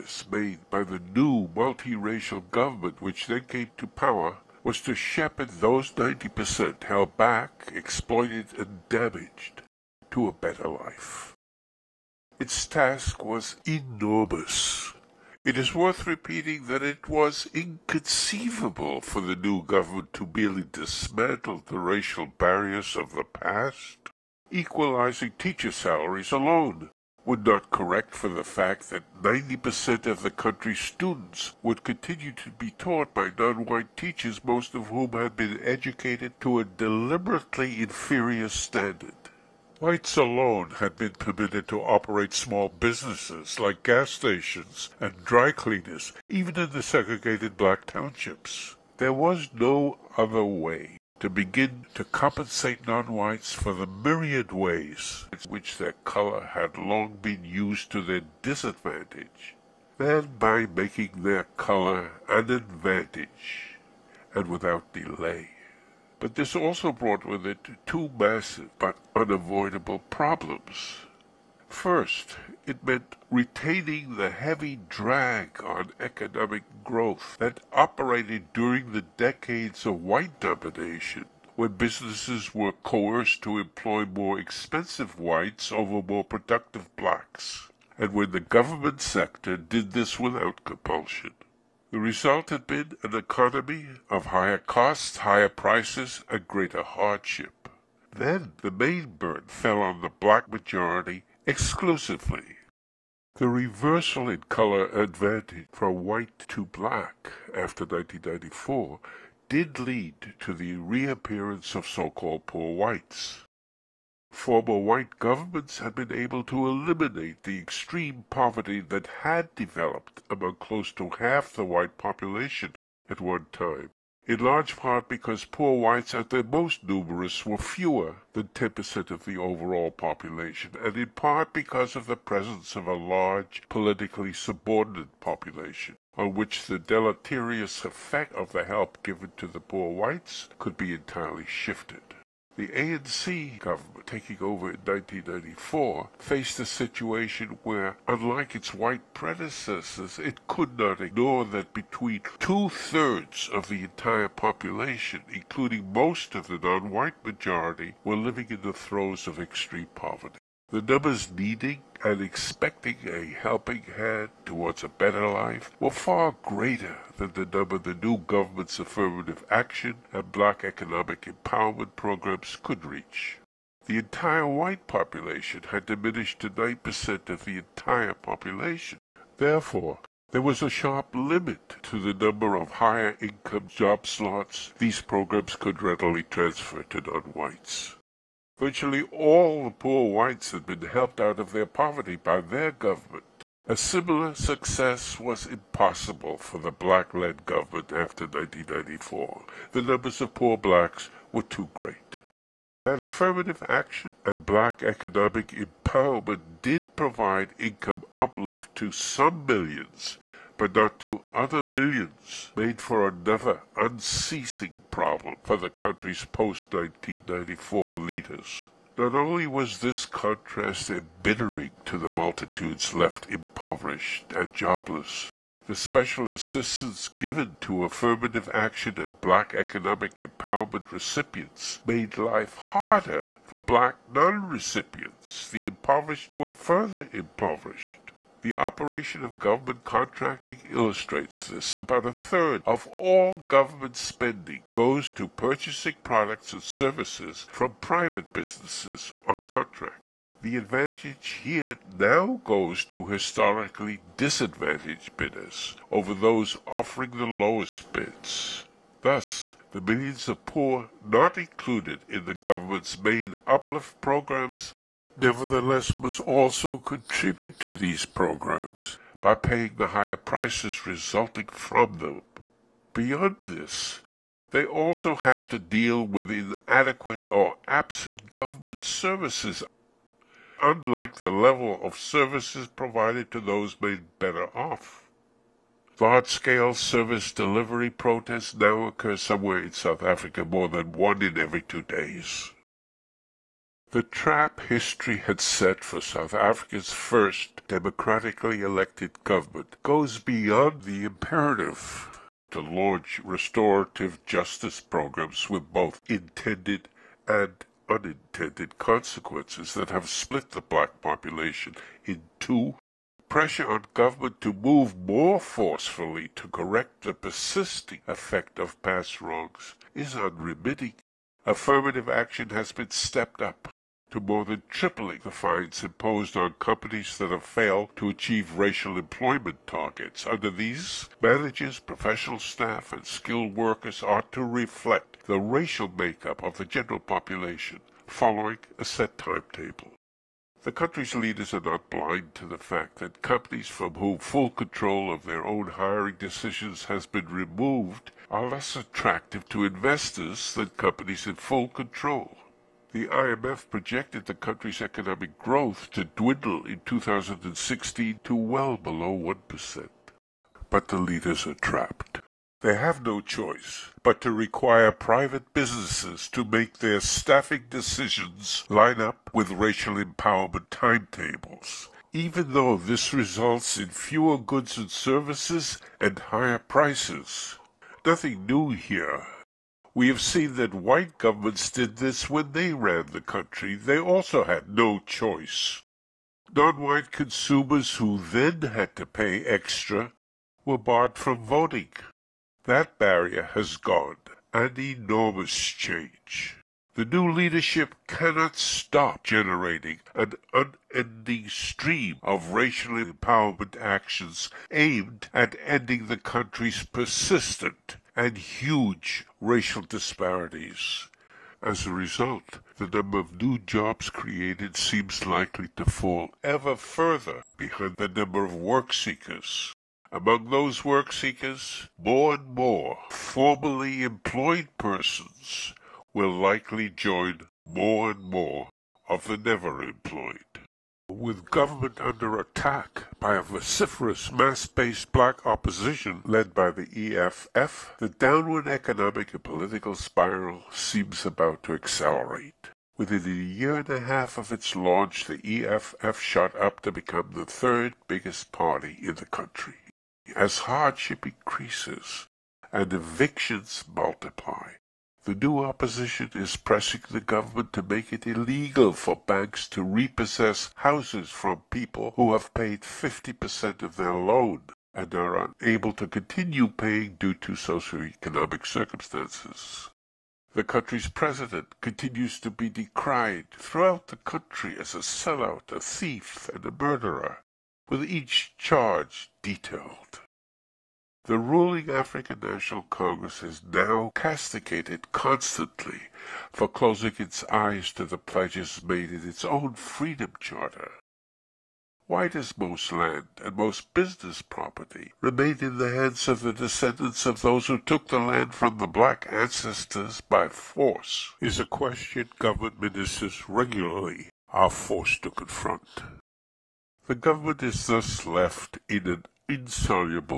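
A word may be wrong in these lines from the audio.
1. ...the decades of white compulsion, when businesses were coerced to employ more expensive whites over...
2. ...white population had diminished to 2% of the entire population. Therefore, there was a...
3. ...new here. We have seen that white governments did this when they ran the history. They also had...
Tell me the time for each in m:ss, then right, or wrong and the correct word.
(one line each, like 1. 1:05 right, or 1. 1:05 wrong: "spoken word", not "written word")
1. 1:18 wrong: "domination", not "compulsion"
2. 2:54 wrong: "9", not "2"
3. 6:18 wrong: "country", not "history".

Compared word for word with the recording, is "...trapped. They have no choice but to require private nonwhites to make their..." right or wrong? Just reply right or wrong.
wrong.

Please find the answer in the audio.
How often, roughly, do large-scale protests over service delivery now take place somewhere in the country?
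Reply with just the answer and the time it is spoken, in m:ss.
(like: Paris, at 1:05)
more than one in every two days, at 4:50.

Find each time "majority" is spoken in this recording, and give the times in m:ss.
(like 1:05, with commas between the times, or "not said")
1:40, 2:37.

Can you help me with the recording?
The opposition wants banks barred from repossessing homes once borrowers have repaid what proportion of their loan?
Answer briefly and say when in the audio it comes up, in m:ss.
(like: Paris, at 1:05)
50%, at 7:42.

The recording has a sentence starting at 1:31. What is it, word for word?
The result had been an economy of higher costs, higher prices, and greater hardship.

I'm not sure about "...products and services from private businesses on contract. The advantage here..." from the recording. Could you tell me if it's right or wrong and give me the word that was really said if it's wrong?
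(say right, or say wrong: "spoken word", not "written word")
right.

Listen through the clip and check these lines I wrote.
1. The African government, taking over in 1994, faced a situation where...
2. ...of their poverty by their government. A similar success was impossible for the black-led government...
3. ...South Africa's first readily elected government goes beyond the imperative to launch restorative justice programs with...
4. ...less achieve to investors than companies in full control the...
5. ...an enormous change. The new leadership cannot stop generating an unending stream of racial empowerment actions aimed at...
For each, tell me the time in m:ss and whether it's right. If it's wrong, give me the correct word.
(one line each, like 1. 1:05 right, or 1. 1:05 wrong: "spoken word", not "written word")
1. 2:22 wrong: "ANC", not "African"
2. 3:11 right
3. 4:56 wrong: "democratically", not "readily"
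4. 5:48 wrong: "attractive", not "achieve"
5. 6:34 right.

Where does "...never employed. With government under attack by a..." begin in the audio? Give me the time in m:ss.
7:09.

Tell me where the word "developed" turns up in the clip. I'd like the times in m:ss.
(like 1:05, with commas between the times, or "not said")
1:59.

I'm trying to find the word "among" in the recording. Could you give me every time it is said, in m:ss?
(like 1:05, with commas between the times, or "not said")
2:00, 7:00.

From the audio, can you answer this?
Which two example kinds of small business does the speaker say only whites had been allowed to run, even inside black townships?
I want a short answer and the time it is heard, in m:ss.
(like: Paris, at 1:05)
gas stations and dry cleaners, at 0:43.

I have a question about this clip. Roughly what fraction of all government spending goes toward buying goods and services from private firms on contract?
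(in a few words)
a third.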